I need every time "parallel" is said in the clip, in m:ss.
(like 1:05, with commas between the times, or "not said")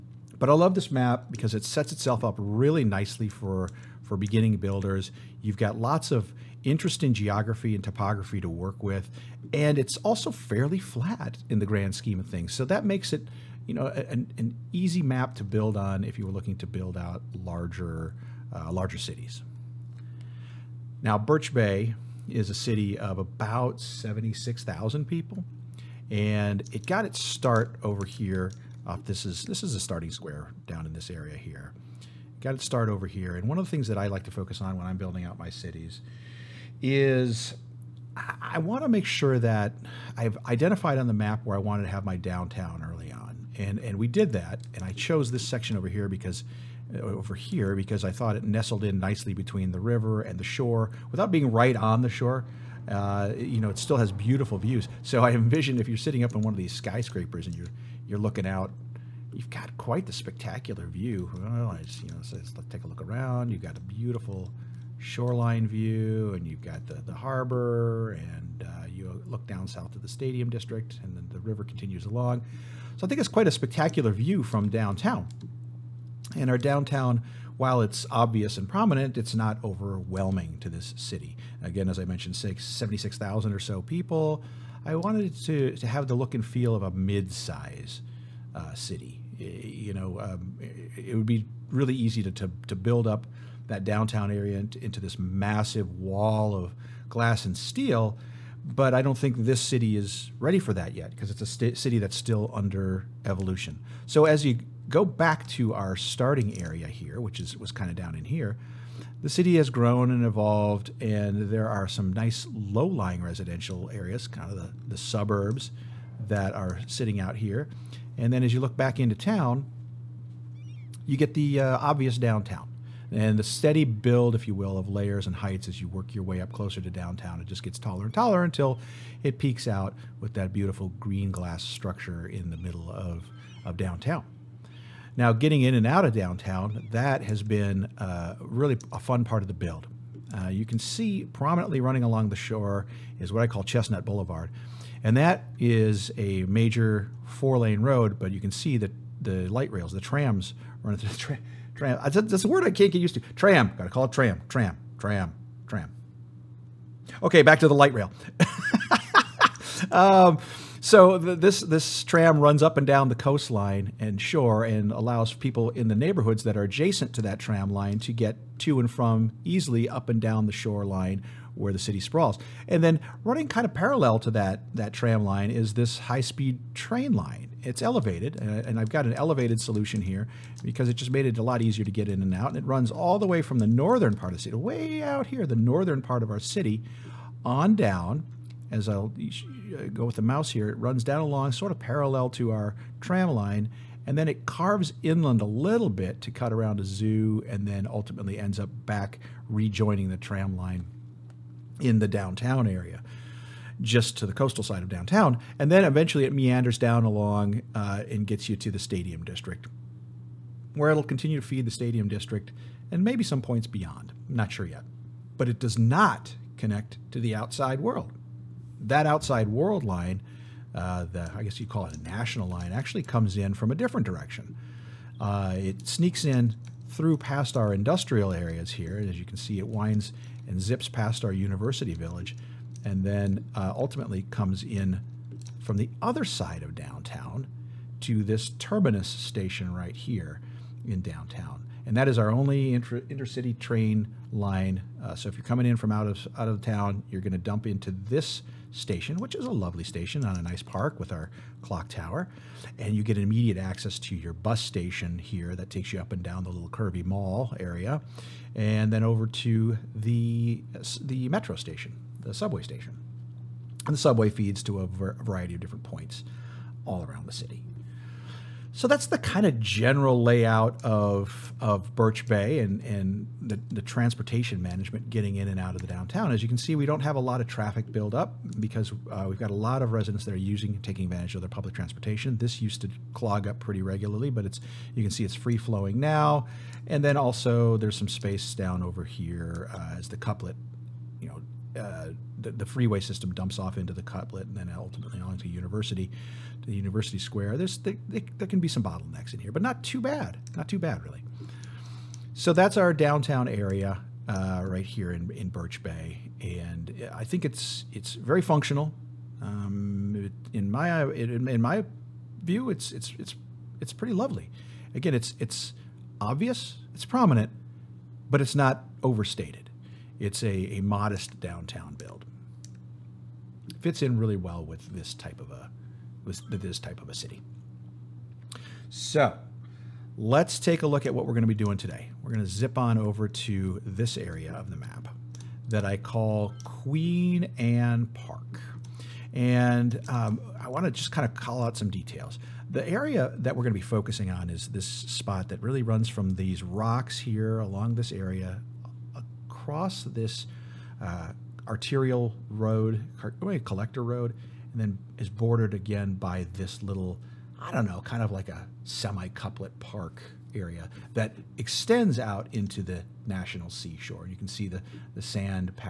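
2:53, 3:11.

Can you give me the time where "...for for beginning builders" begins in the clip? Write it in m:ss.
0:03.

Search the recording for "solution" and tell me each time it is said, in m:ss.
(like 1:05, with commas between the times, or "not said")
2:59.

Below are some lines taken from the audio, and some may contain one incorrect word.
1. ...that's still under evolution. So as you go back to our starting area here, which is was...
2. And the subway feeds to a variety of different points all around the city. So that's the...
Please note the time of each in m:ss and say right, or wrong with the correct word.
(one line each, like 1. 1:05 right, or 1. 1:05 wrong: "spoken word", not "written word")
1. 1:41 right
2. 4:23 right.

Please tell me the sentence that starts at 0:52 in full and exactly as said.
Uh, you know, it still has beautiful views.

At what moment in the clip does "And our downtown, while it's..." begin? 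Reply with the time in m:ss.
1:16.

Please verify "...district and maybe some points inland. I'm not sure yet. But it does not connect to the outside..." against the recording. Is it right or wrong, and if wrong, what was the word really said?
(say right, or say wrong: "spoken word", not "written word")
wrong: "beyond", not "inland".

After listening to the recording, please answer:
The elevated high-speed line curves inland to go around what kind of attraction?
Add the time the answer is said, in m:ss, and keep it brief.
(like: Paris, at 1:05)
A zoo, at 3:16.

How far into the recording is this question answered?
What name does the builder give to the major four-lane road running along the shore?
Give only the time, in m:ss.
2:23.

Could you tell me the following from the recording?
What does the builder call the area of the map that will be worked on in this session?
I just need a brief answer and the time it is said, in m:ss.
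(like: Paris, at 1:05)
Queen Anne Park, at 5:36.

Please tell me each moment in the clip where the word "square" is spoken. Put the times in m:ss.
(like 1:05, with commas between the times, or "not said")
0:30, 4:57.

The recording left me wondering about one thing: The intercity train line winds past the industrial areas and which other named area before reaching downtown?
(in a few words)
University village.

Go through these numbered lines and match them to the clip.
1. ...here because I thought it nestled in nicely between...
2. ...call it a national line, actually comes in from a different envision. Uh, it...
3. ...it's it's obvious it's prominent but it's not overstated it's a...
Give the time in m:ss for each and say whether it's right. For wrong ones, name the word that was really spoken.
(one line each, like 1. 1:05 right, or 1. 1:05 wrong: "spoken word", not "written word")
1. 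0:47 right
2. 3:41 wrong: "direction", not "envision"
3. 5:15 right.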